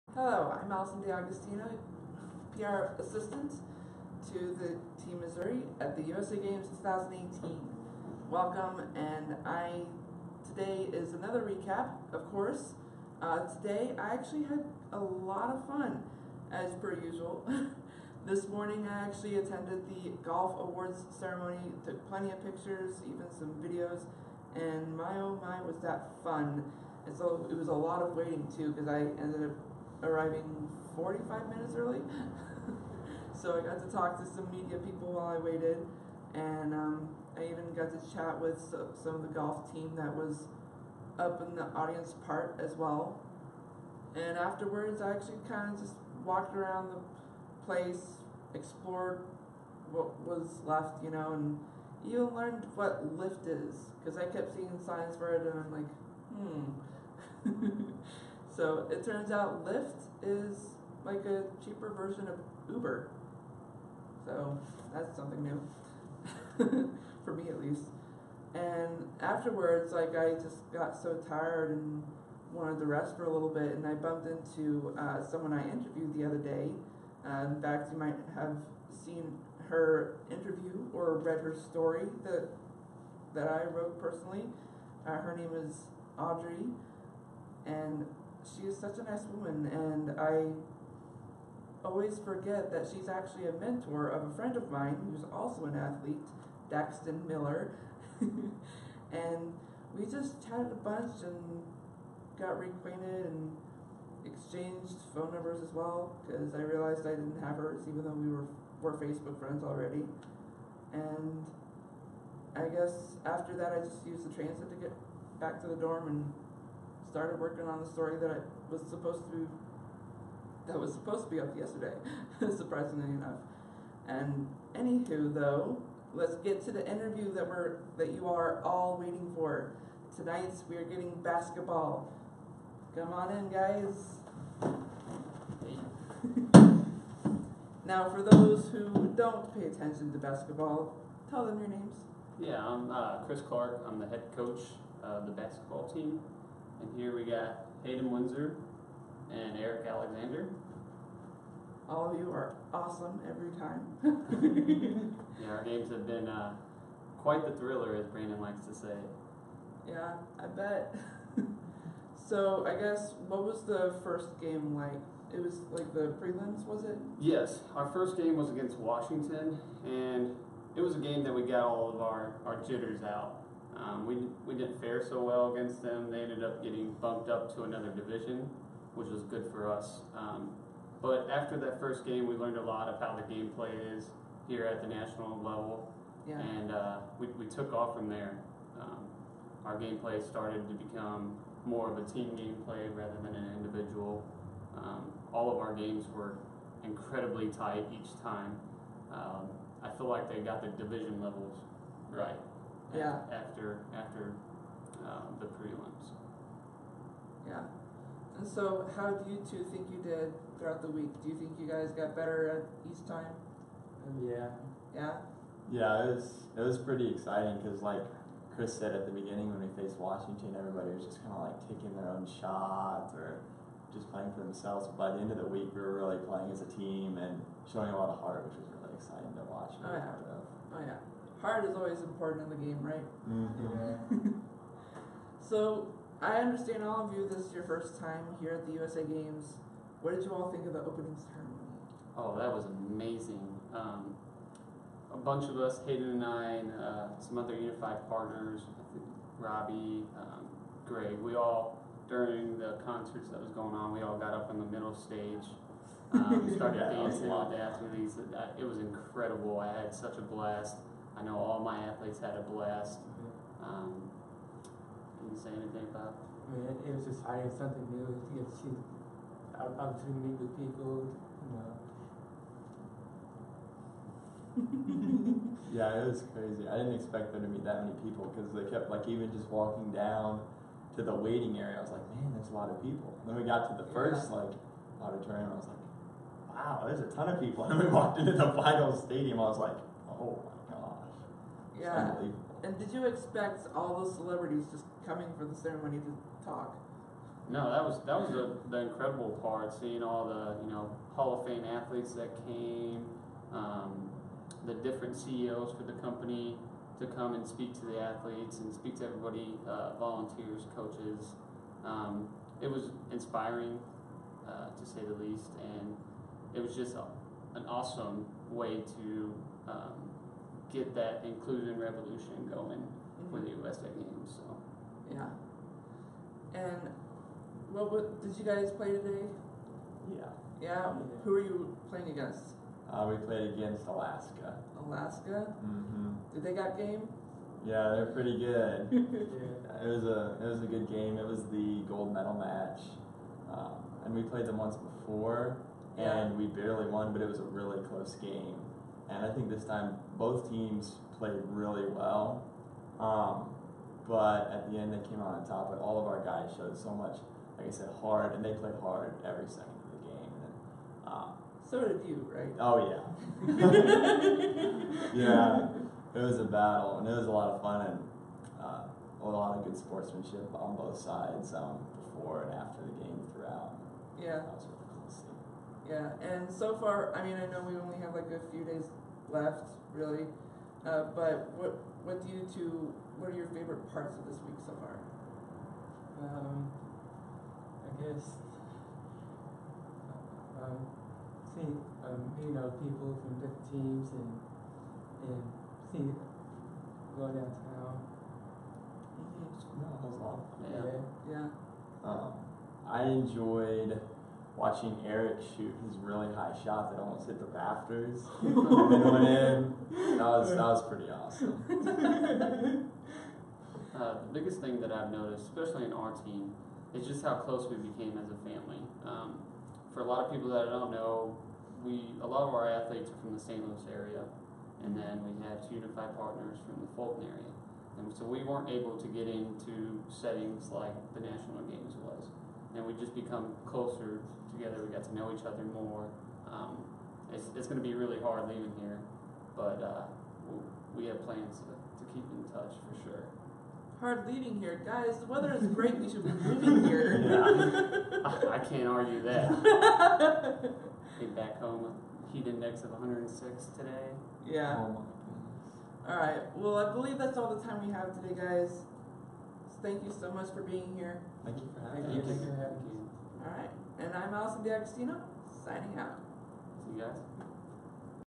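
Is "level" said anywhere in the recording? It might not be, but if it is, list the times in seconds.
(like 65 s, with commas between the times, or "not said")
185 s, 201 s.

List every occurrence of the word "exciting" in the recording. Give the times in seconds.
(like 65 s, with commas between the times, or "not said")
217 s, 228 s.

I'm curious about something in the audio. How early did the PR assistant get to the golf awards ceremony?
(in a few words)
45 minutes.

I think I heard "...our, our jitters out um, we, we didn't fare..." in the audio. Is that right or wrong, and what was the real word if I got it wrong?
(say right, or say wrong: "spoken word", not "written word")
right.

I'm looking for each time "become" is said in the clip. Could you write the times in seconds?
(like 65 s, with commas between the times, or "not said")
190 s, 433 s.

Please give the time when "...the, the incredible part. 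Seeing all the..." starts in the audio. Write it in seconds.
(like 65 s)
298 s.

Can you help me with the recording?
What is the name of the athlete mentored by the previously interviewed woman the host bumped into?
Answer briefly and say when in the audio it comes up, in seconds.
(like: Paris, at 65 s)
Daxton Miller, at 96 s.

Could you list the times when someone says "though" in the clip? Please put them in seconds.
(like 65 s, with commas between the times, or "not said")
108 s, 125 s.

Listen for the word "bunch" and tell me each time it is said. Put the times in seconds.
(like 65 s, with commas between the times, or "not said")
100 s, 245 s.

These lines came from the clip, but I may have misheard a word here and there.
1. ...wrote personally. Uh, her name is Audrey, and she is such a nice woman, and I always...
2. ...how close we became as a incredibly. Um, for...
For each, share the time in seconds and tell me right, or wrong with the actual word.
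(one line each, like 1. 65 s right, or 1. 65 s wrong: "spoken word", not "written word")
1. 83 s right
2. 417 s wrong: "family", not "incredibly".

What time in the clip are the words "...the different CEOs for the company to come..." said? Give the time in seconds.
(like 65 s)
304 s.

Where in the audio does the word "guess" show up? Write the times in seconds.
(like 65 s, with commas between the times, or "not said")
112 s, 162 s, 388 s.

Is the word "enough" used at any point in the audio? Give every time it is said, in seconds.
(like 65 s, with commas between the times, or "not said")
123 s.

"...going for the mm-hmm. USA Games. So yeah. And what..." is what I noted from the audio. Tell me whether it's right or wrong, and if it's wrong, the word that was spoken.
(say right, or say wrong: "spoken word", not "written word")
right.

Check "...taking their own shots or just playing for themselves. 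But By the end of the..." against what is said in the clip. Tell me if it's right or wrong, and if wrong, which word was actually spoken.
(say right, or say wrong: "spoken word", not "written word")
right.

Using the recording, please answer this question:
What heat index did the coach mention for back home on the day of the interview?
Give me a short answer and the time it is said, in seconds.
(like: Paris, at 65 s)
106, at 452 s.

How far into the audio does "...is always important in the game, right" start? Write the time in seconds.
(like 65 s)
231 s.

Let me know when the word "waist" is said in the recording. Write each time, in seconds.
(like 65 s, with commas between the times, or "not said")
not said.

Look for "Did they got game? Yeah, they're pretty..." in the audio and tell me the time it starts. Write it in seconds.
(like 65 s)
336 s.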